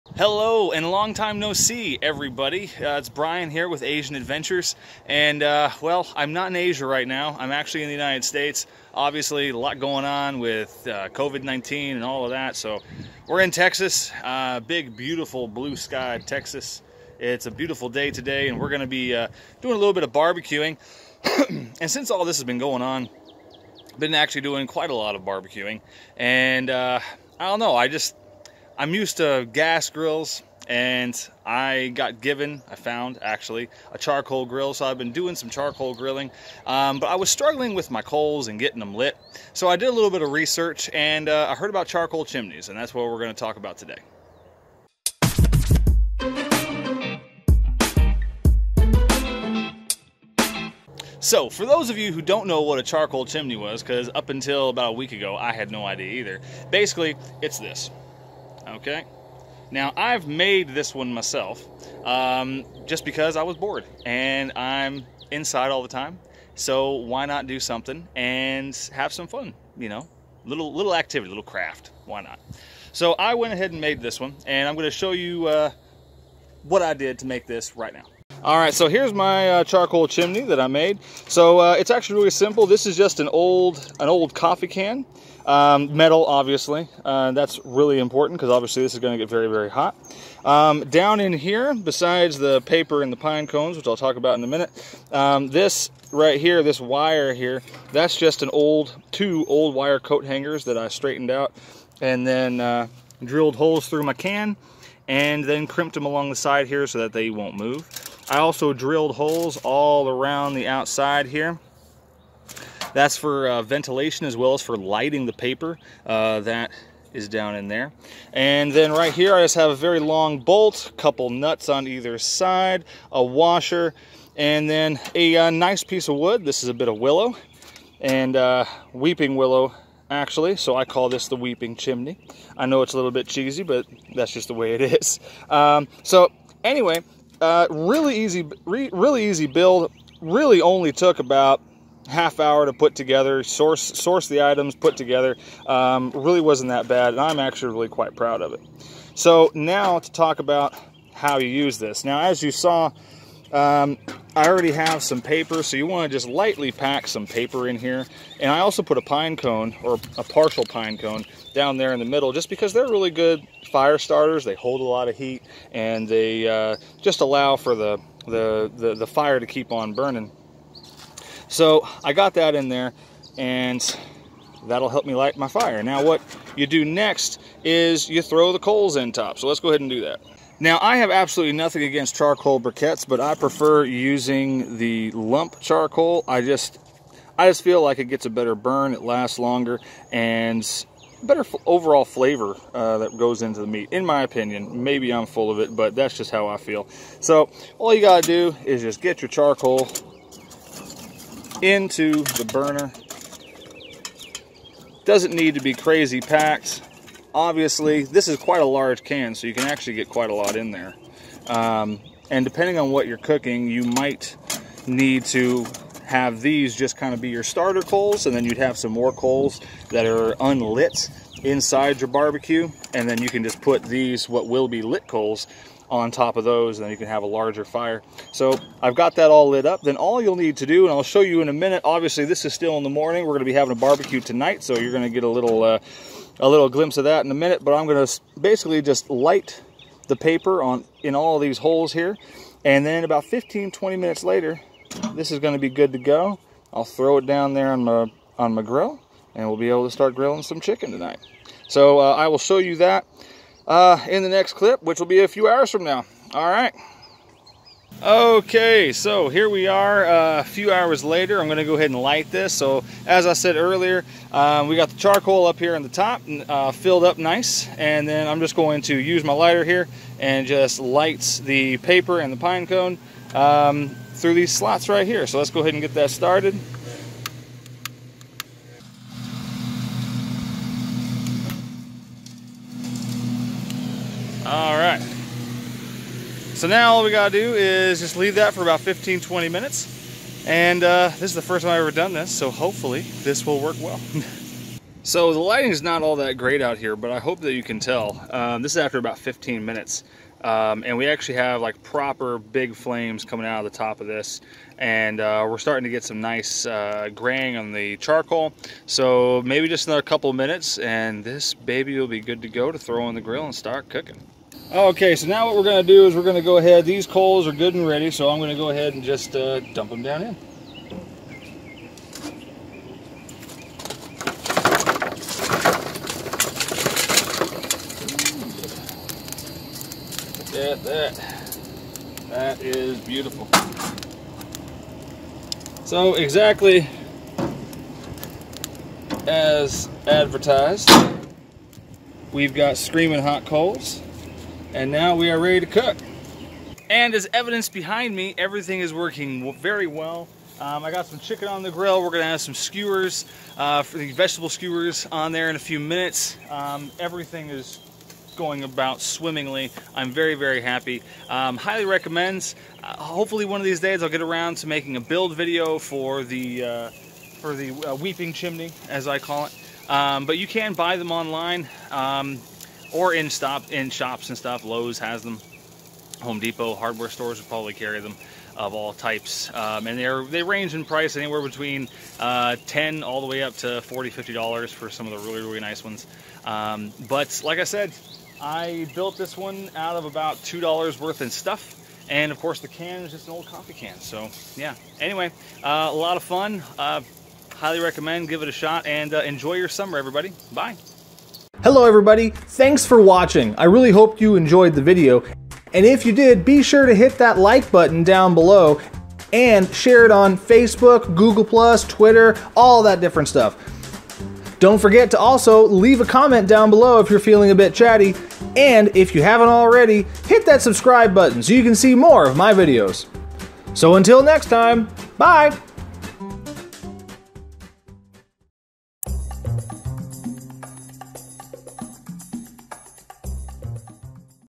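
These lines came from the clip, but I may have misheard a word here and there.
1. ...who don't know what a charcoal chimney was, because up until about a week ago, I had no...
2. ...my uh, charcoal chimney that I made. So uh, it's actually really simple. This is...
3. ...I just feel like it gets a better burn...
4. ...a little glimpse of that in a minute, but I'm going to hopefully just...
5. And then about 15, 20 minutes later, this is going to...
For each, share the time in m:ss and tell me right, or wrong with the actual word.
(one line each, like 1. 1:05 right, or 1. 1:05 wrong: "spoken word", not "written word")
1. 0:52 right
2. 1:19 right
3. 3:07 right
4. 3:56 wrong: "basically", not "hopefully"
5. 4:02 right.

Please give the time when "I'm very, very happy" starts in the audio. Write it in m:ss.
5:59.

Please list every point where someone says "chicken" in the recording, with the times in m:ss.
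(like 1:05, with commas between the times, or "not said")
4:10, 5:51.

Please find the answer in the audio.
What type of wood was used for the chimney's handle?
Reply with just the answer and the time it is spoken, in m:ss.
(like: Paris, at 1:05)
weeping willow, at 2:08.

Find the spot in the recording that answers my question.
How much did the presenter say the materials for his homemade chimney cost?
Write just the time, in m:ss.
6:30.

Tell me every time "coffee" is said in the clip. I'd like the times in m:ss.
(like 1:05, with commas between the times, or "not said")
1:24, 6:33.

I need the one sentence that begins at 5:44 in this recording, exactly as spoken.
And now we are ready to cook.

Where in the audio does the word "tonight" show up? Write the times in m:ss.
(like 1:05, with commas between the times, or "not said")
3:54, 4:10.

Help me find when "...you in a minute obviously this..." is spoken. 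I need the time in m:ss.
3:51.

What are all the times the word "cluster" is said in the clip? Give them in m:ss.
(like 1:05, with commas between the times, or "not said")
not said.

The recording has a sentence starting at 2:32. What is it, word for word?
Now, as you saw um, I already have some paper, so you want to just lightly pack some paper in here.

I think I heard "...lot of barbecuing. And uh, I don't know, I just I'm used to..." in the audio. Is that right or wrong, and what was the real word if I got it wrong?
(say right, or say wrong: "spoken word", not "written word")
right.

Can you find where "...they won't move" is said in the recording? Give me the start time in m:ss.
1:47.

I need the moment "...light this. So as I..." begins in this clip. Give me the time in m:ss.
4:22.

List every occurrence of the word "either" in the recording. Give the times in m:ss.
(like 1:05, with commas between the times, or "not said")
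0:56, 2:01.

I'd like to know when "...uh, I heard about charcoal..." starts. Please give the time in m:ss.
0:41.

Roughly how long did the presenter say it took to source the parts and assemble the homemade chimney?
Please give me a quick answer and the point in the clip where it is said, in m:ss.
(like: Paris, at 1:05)
half hour, at 2:22.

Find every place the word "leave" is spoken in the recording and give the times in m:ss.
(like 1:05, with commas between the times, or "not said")
4:48, 6:55.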